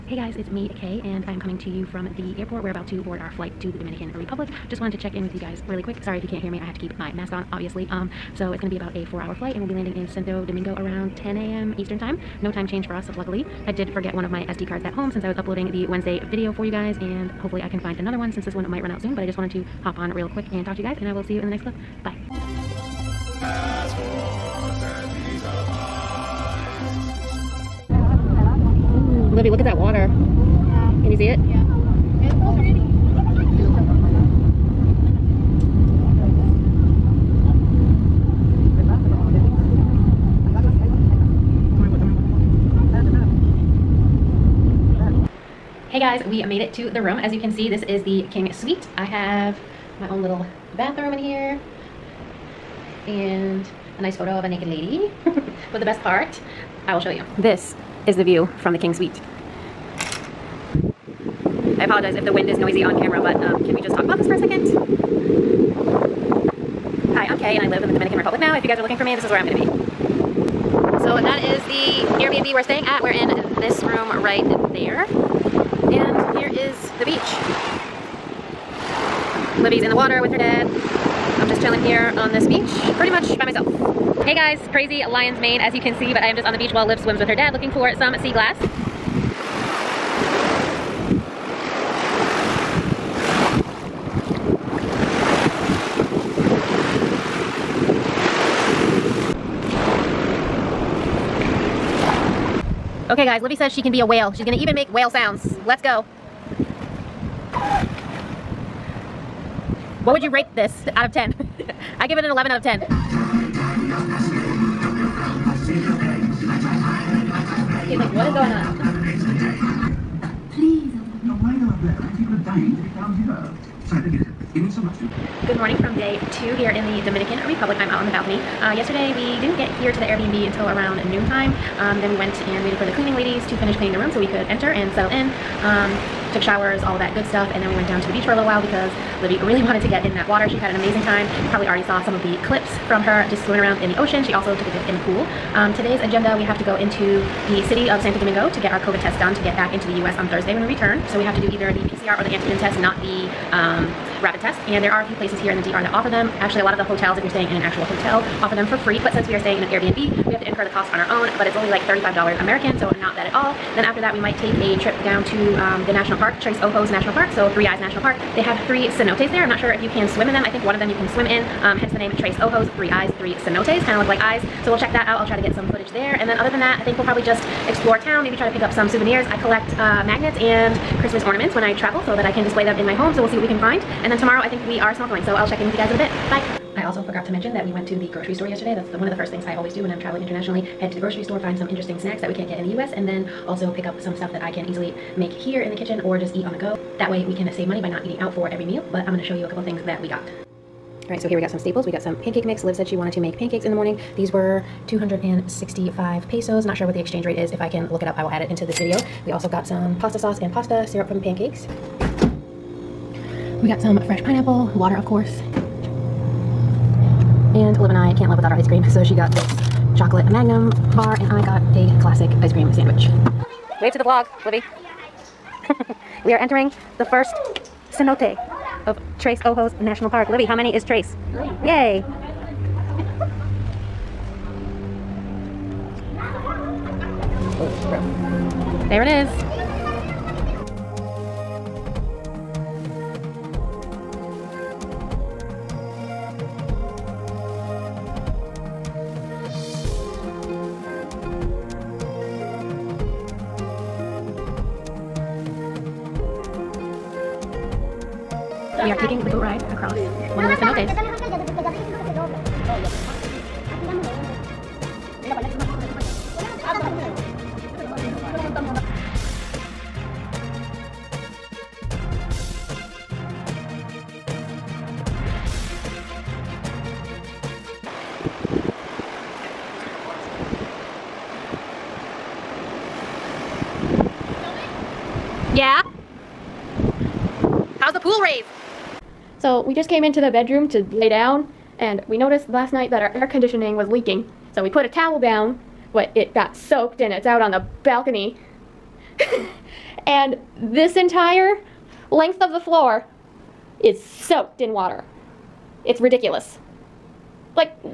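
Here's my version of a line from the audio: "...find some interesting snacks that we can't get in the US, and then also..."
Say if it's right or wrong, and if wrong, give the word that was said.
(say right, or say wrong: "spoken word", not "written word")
right.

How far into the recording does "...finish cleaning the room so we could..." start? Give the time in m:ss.
2:13.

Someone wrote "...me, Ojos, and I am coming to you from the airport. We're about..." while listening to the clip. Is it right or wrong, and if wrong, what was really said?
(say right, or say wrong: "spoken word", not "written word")
wrong: "Kay", not "Ojos".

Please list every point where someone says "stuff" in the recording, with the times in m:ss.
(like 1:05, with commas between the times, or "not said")
2:17, 3:14.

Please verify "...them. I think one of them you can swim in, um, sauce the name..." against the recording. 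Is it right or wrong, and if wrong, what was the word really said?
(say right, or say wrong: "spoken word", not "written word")
wrong: "hence", not "sauce".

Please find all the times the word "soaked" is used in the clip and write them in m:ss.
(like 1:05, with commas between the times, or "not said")
4:56, 5:04.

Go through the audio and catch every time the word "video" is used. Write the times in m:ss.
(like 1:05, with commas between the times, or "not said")
0:16, 3:28.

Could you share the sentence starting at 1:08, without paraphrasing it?
If you guys are looking for me, this is where I'm gonna be.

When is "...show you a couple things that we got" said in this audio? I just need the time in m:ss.
3:19.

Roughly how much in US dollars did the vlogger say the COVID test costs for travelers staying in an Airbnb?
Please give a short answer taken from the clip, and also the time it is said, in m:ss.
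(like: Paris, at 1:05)
$35, at 2:41.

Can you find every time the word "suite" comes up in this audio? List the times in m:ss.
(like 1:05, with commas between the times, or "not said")
0:48, 0:58.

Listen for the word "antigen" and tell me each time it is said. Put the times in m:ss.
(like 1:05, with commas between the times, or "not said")
2:32.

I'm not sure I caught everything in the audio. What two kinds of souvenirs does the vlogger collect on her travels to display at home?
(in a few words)
Magnets and Christmas ornaments.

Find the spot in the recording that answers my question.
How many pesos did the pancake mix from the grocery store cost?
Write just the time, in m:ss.
3:24.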